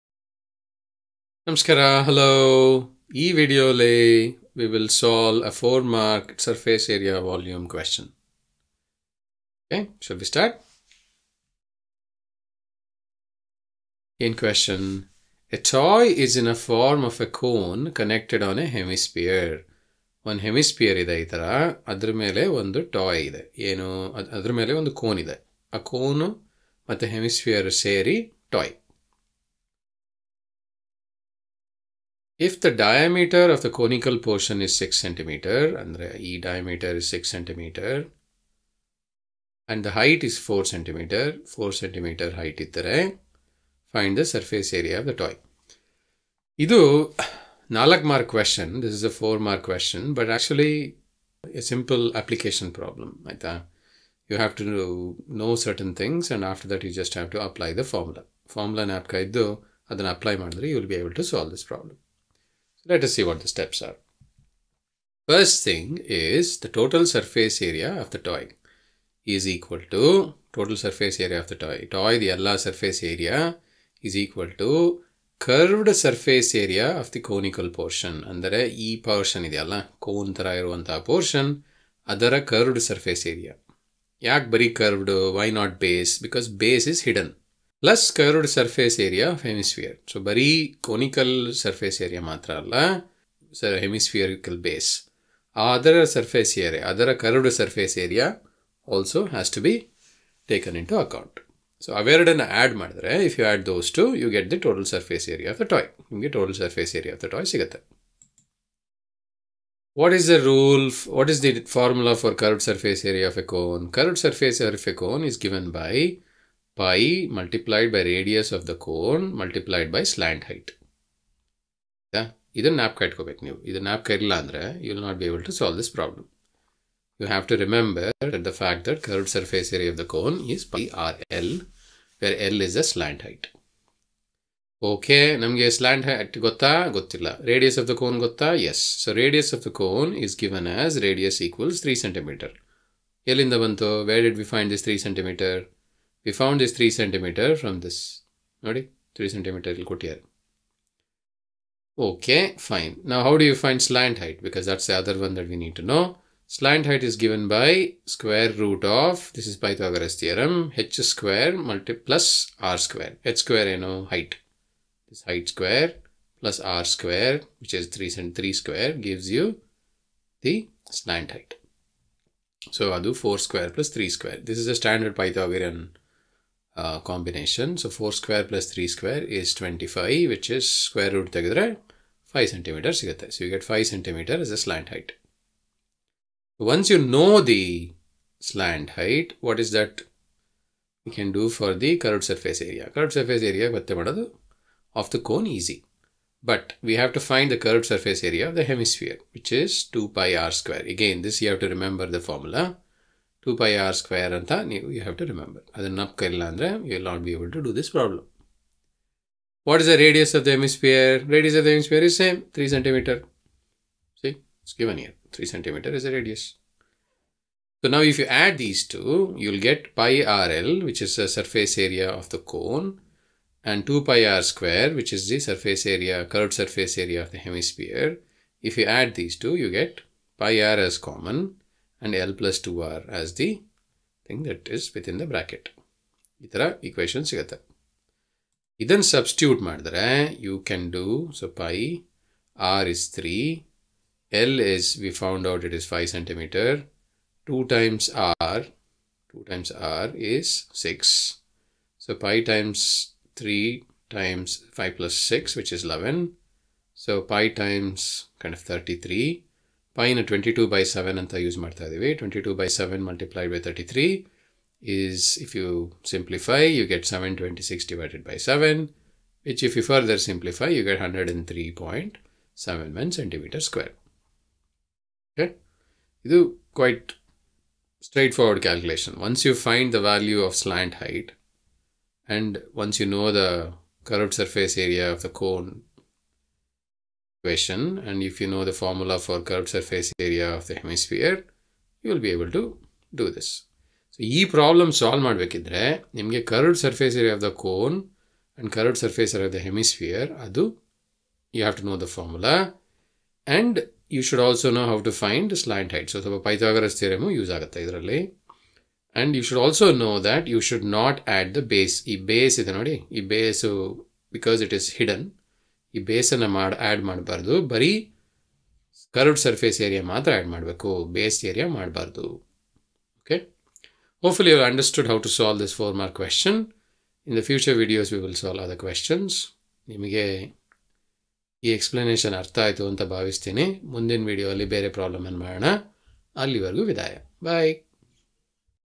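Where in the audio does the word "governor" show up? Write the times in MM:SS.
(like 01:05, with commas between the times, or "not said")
not said.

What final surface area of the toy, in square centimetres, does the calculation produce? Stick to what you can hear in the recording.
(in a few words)
103.71.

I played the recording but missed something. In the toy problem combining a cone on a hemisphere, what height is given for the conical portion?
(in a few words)
4 cm.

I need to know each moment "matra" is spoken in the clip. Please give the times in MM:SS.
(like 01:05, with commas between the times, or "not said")
01:32, 01:42.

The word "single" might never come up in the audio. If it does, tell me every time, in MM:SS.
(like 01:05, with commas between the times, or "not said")
not said.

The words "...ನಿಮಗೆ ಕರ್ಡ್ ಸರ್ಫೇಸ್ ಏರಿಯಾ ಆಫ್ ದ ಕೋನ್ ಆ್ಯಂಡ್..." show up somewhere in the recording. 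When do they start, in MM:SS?
04:56.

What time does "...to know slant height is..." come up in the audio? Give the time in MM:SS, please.
02:35.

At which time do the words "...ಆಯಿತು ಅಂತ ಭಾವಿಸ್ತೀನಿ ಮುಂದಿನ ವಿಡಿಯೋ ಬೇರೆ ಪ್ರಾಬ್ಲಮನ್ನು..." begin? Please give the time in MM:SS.
05:32.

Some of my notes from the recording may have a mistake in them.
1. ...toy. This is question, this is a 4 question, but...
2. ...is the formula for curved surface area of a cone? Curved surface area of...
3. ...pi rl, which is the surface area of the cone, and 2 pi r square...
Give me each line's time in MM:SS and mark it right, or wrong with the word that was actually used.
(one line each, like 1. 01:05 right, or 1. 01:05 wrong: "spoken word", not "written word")
1. 00:45 right
2. 01:51 right
3. 03:39 right.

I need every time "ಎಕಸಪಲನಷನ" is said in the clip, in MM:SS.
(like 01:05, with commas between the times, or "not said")
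05:31.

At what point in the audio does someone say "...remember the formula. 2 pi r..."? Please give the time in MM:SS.
03:21.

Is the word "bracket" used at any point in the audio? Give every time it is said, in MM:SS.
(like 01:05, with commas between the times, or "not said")
03:55.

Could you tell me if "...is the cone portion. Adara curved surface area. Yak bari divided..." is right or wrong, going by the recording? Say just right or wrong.
wrong.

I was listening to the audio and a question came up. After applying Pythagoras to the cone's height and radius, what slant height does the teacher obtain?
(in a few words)
5 centimeters.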